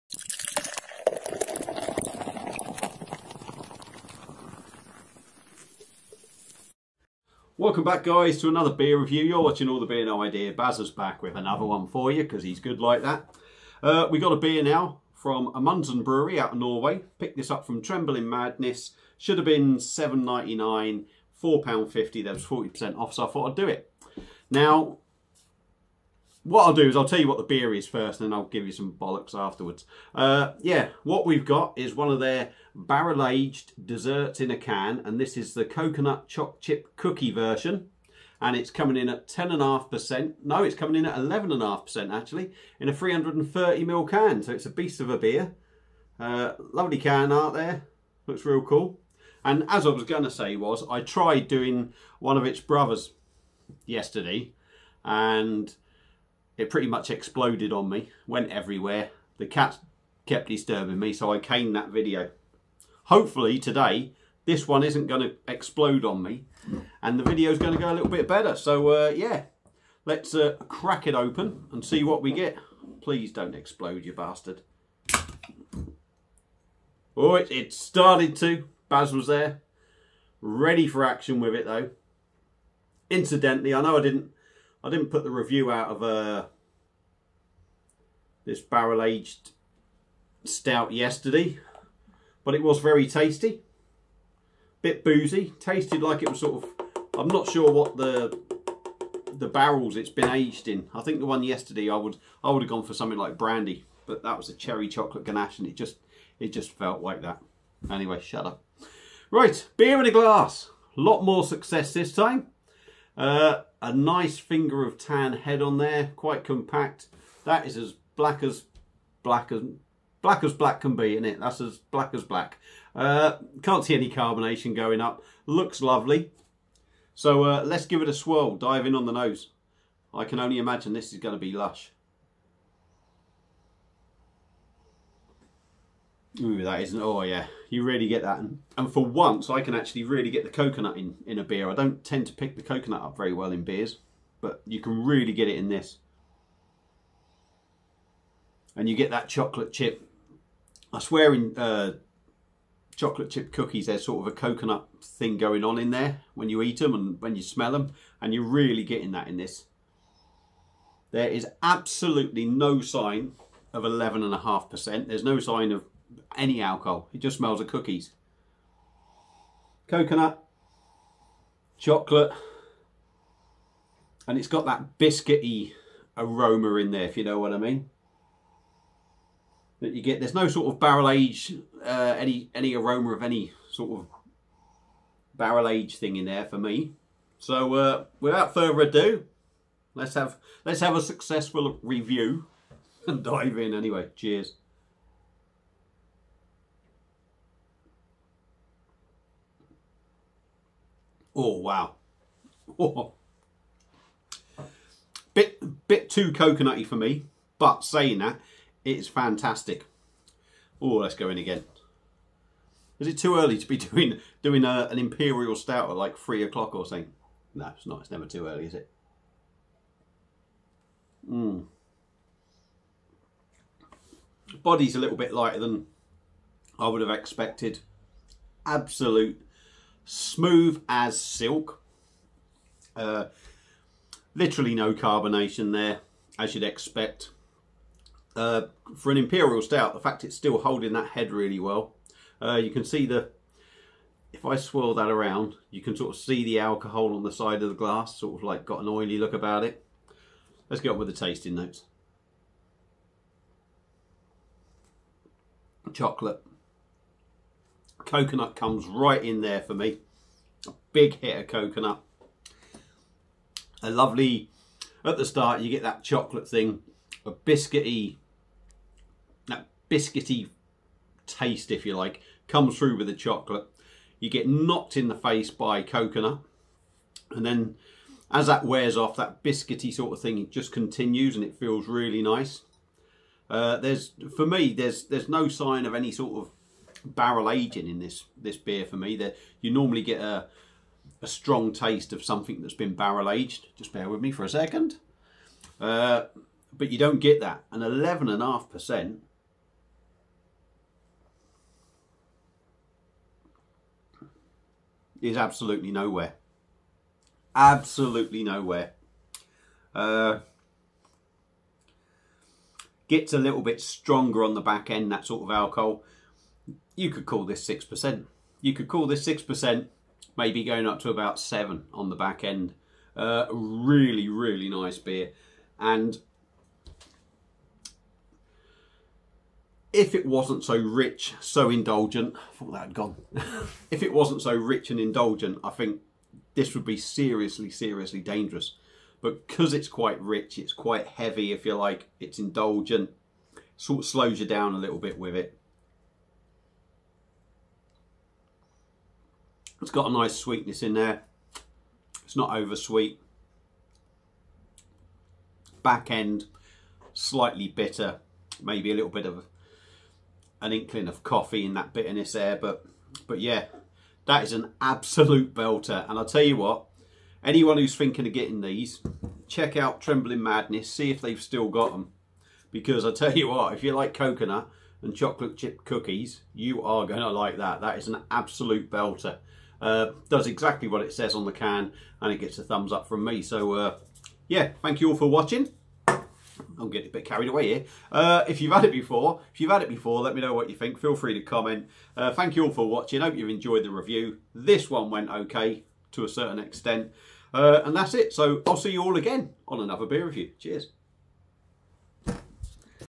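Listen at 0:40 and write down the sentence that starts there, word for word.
No, it's coming in at 11.5% actually in a 330ml can.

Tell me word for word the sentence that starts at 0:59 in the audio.
The cat kept disturbing me, so I caned that video.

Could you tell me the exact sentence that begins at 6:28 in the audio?
Uh, if you've had it before, if you've had it before, let me know what you think.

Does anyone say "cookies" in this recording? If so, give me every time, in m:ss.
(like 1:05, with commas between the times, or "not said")
0:36, 2:33, 2:47, 6:15.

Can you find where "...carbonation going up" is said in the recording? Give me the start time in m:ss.
2:04.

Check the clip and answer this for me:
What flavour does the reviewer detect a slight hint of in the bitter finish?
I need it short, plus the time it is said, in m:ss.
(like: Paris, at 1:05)
Coffee, at 6:01.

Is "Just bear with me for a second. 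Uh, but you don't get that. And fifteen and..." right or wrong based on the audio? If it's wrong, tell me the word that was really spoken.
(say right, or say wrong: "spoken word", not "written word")
wrong: "eleven", not "fifteen".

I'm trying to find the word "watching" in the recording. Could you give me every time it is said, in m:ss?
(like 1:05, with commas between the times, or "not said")
0:09, 6:25, 6:32.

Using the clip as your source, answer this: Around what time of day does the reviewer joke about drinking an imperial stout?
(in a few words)
3 o'clock.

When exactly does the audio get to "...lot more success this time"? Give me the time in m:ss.
1:51.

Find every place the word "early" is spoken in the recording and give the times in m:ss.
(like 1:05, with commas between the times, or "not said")
3:33, 3:38.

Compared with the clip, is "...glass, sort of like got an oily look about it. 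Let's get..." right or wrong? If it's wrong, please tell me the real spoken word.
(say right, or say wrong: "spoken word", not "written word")
right.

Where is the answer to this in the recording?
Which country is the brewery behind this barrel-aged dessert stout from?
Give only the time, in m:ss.
0:16.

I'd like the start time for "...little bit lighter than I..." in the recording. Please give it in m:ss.
3:44.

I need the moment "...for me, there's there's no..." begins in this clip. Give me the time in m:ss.
4:44.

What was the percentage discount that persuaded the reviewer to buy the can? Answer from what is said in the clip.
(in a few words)
40%.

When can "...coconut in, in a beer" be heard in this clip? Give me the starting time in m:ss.
2:20.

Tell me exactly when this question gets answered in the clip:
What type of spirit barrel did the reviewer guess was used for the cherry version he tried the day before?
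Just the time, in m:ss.
1:43.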